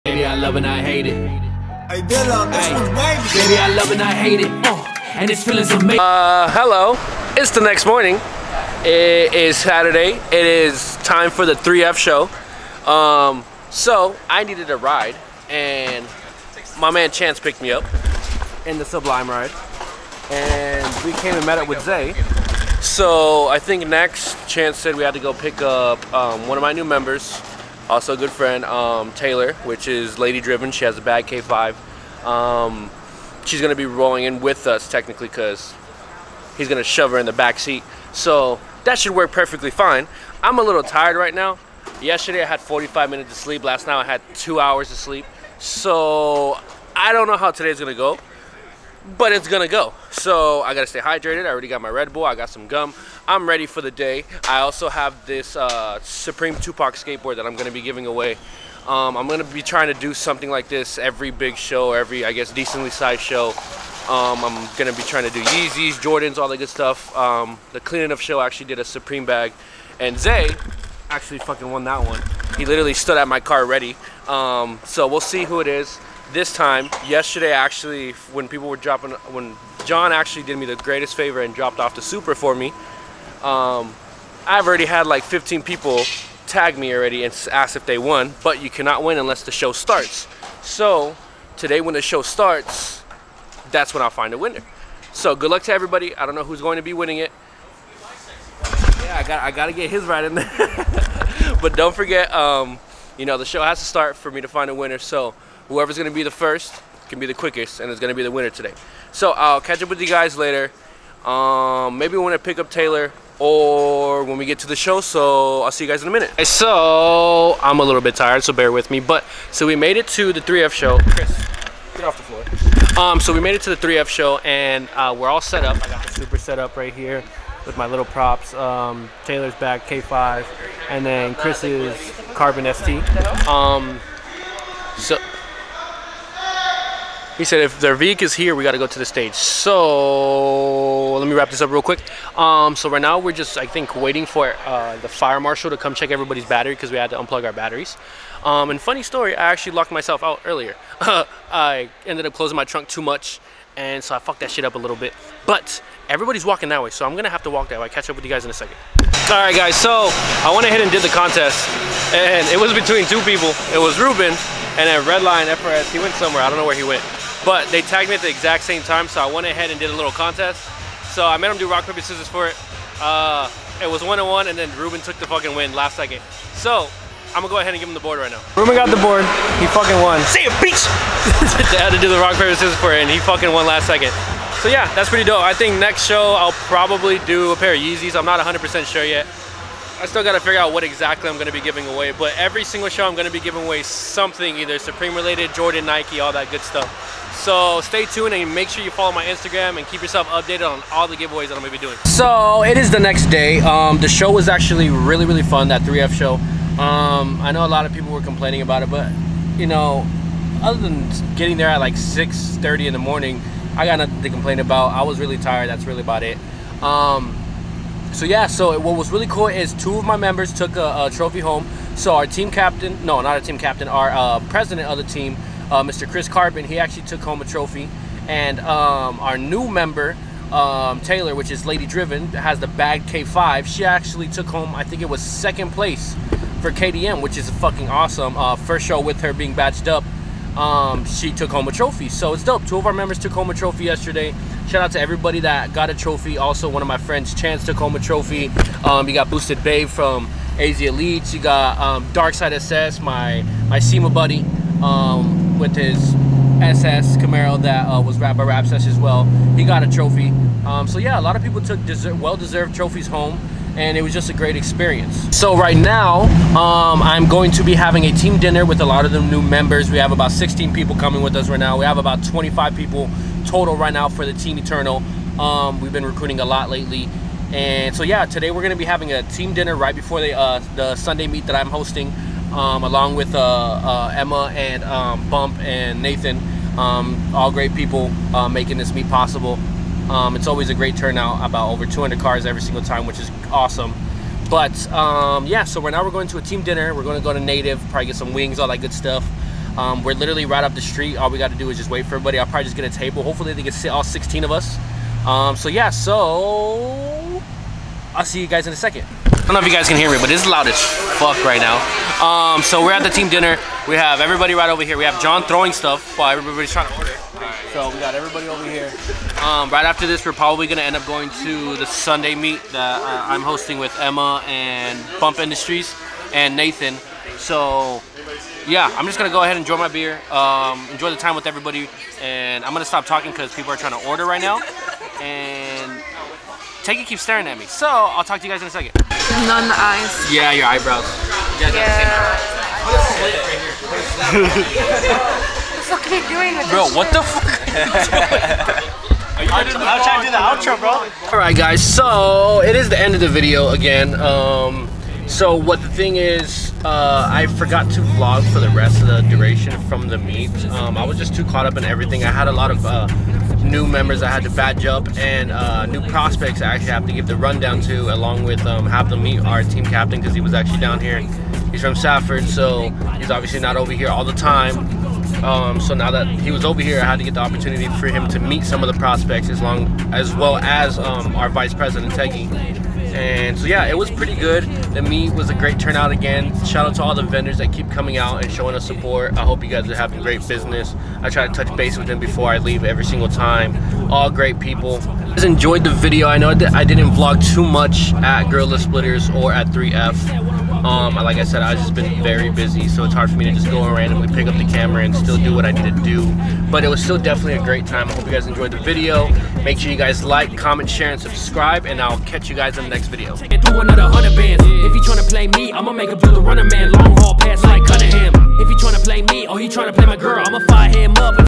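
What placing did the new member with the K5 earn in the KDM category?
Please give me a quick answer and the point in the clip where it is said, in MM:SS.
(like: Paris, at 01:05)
second place, at 03:55.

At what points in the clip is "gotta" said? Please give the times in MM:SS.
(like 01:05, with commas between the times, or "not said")
00:50, 01:39, 03:10.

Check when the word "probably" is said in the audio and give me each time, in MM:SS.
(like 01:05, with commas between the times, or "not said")
03:06, 04:57, 05:02, 05:20.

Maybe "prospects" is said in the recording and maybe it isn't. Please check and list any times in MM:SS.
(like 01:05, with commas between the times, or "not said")
06:06, 06:18.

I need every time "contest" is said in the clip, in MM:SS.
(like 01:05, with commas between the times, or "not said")
02:41, 02:50.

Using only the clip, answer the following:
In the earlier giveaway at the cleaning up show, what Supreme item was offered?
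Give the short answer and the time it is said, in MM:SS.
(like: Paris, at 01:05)
Supreme bag, at 01:08.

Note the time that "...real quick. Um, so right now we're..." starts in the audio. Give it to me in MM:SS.
02:21.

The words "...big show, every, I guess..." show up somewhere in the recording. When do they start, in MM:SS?
01:01.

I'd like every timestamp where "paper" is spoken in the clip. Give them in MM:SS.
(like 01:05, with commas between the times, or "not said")
02:51, 03:02.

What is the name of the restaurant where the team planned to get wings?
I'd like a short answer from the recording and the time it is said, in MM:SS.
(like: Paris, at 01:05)
Native, at 04:57.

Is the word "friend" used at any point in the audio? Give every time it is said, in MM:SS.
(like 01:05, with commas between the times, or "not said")
00:28, 04:06.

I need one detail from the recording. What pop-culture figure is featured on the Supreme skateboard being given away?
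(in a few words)
Tupac.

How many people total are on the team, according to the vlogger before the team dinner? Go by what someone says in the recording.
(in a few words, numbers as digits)
25.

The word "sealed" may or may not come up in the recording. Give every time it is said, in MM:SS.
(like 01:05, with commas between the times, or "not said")
not said.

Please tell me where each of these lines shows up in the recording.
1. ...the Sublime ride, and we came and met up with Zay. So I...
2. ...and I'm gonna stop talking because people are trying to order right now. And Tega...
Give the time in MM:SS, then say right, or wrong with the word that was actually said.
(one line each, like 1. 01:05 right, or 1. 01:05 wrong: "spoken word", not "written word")
1. 00:18 right
2. 05:32 right.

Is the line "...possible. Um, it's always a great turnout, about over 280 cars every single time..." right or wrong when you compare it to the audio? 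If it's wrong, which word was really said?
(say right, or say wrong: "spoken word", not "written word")
wrong: "200", not "280".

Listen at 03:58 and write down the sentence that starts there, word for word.
Uh, first show with her being batched up, um, she took home a trophy.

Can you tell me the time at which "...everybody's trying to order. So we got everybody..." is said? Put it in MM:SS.
05:16.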